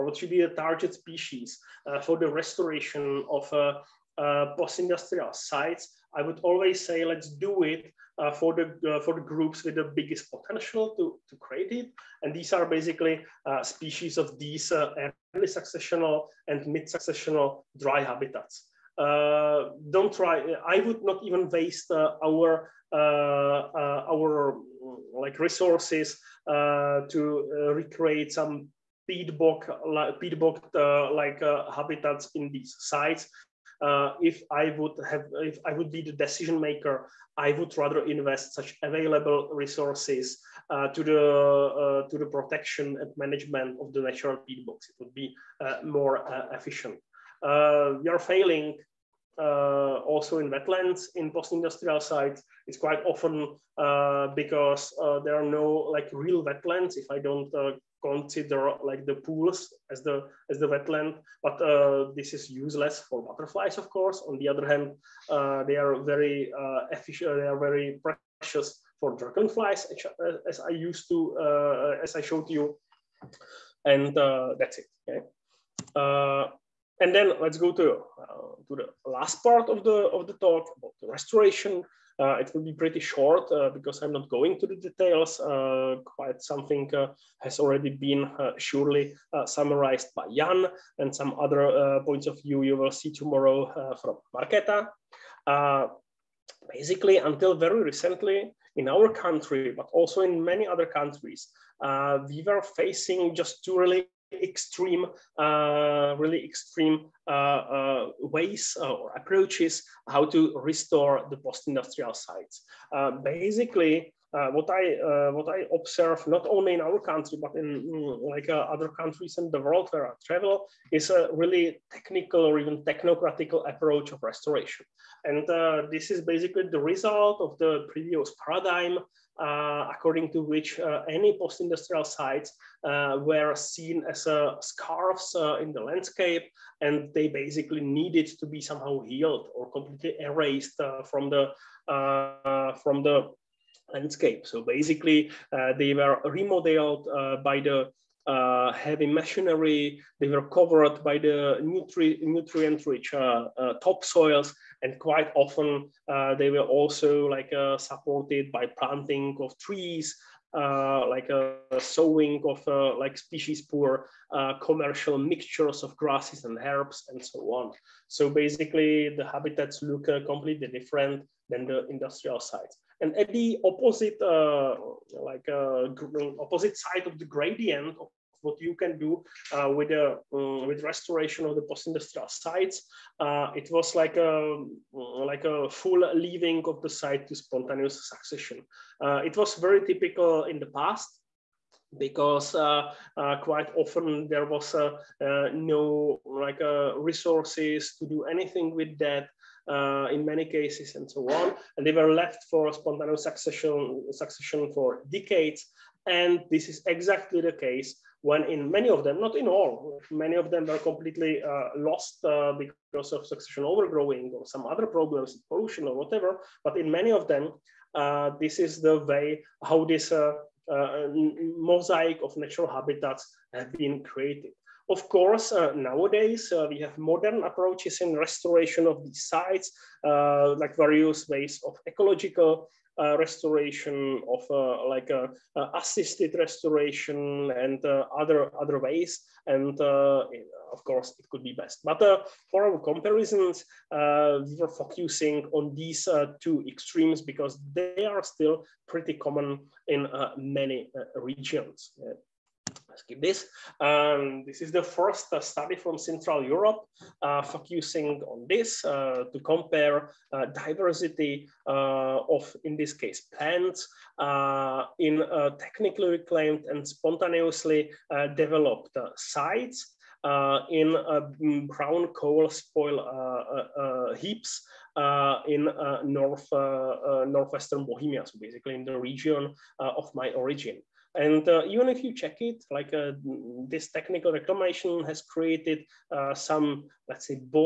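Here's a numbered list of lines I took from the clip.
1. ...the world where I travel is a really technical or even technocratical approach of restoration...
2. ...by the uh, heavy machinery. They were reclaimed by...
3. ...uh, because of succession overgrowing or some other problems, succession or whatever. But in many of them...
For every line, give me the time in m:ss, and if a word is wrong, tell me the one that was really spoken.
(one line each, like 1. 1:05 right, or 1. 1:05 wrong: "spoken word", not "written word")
1. 1:59 right
2. 2:27 wrong: "covered", not "reclaimed"
3. 3:32 wrong: "pollution", not "succession".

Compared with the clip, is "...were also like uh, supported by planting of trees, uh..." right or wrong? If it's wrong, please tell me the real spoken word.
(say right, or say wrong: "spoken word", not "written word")
right.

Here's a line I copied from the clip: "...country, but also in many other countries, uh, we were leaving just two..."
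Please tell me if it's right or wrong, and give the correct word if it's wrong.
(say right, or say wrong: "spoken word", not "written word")
wrong: "facing", not "leaving".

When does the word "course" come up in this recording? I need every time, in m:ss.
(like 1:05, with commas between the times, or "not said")
1:03, 3:45, 4:00.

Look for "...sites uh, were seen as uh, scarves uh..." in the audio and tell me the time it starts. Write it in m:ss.
2:12.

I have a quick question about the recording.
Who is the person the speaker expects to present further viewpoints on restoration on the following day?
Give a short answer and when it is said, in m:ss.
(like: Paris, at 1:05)
Marketa, at 1:34.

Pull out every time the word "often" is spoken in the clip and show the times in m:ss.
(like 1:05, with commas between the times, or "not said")
0:53, 2:35, 3:13.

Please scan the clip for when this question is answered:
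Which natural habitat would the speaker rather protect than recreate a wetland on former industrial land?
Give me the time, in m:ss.
0:44.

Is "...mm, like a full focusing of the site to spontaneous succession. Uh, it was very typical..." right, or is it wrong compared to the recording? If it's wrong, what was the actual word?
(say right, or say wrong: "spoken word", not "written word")
wrong: "leaving", not "focusing".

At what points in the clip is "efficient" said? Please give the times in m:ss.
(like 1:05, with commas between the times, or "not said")
0:46, 1:06.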